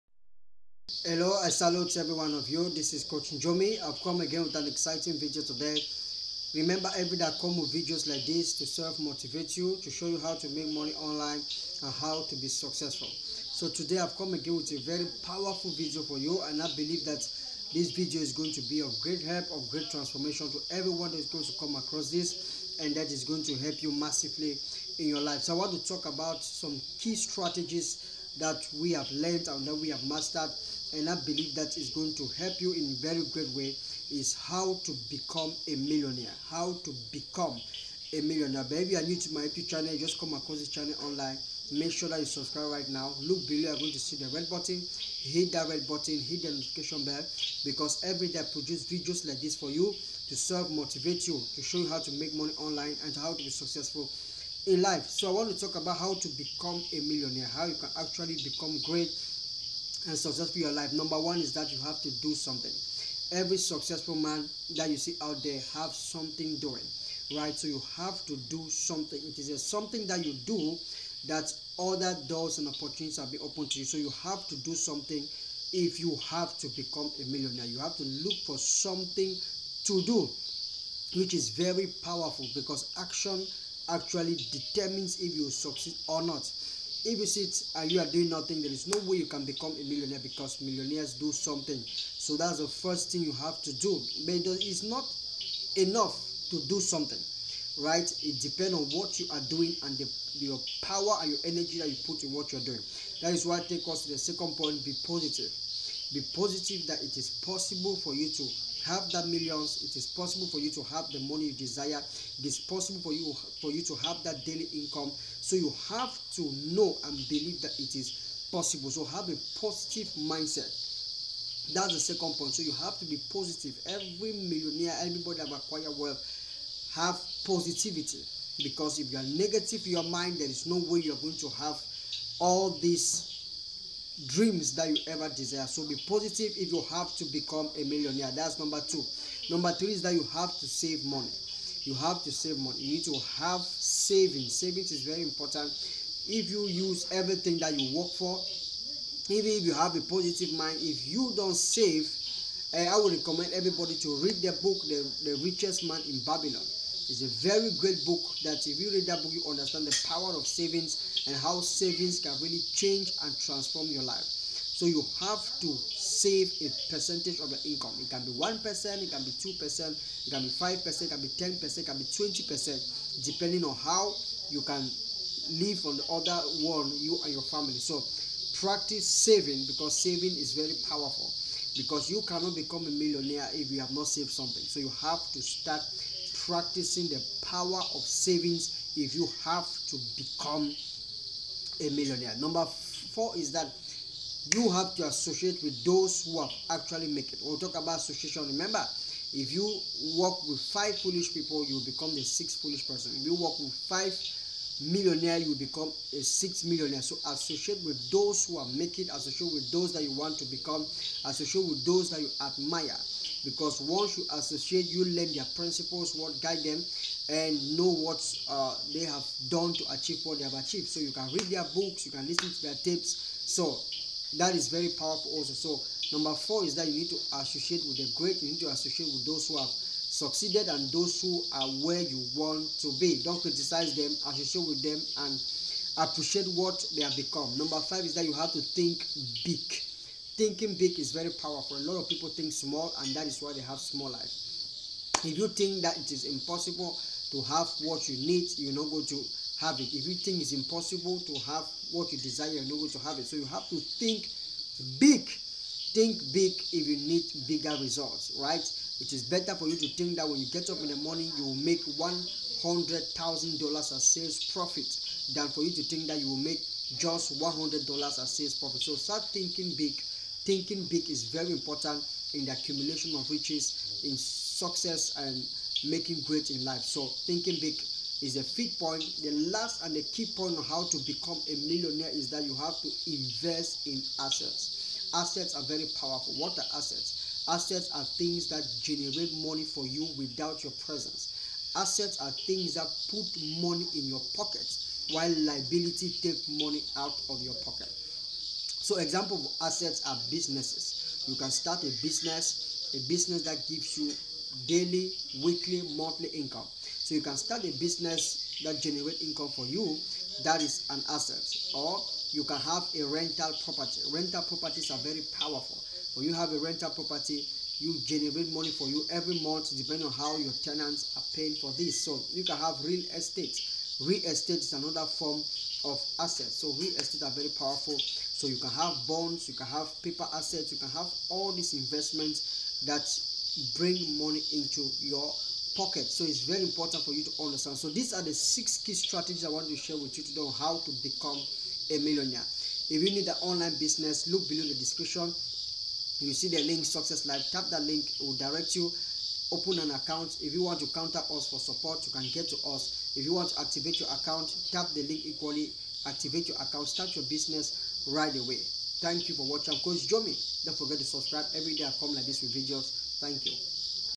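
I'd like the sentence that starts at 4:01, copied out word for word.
A lot of people think small, and that is why they have small life.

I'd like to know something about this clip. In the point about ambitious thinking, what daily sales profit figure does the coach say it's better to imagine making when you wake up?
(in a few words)
$100,000.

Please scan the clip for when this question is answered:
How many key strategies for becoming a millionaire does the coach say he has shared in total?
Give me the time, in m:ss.
5:38.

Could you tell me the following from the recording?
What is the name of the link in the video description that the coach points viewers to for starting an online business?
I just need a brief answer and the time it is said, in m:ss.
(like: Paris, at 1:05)
Success Life, at 5:46.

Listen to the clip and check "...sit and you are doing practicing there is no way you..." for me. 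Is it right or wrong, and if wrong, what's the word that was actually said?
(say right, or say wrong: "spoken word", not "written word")
wrong: "nothing", not "practicing".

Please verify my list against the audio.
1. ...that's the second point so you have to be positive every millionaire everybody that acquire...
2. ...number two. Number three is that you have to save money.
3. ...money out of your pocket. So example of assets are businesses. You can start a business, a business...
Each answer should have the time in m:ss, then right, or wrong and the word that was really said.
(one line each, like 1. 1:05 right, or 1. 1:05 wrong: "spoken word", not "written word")
1. 2:01 right
2. 2:18 right
3. 4:56 right.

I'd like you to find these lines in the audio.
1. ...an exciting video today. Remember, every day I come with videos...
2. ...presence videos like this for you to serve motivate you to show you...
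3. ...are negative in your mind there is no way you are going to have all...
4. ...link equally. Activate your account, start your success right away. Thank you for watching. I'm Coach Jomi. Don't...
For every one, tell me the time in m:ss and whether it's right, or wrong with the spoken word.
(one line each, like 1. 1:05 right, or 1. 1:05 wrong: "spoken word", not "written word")
1. 0:04 right
2. 0:48 wrong: "produce", not "presence"
3. 2:09 right
4. 5:55 wrong: "business", not "success".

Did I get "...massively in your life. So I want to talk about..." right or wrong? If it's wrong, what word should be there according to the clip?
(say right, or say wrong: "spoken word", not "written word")
right.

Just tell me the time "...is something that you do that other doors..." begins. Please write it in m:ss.
1:09.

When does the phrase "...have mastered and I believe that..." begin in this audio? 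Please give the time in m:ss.
0:29.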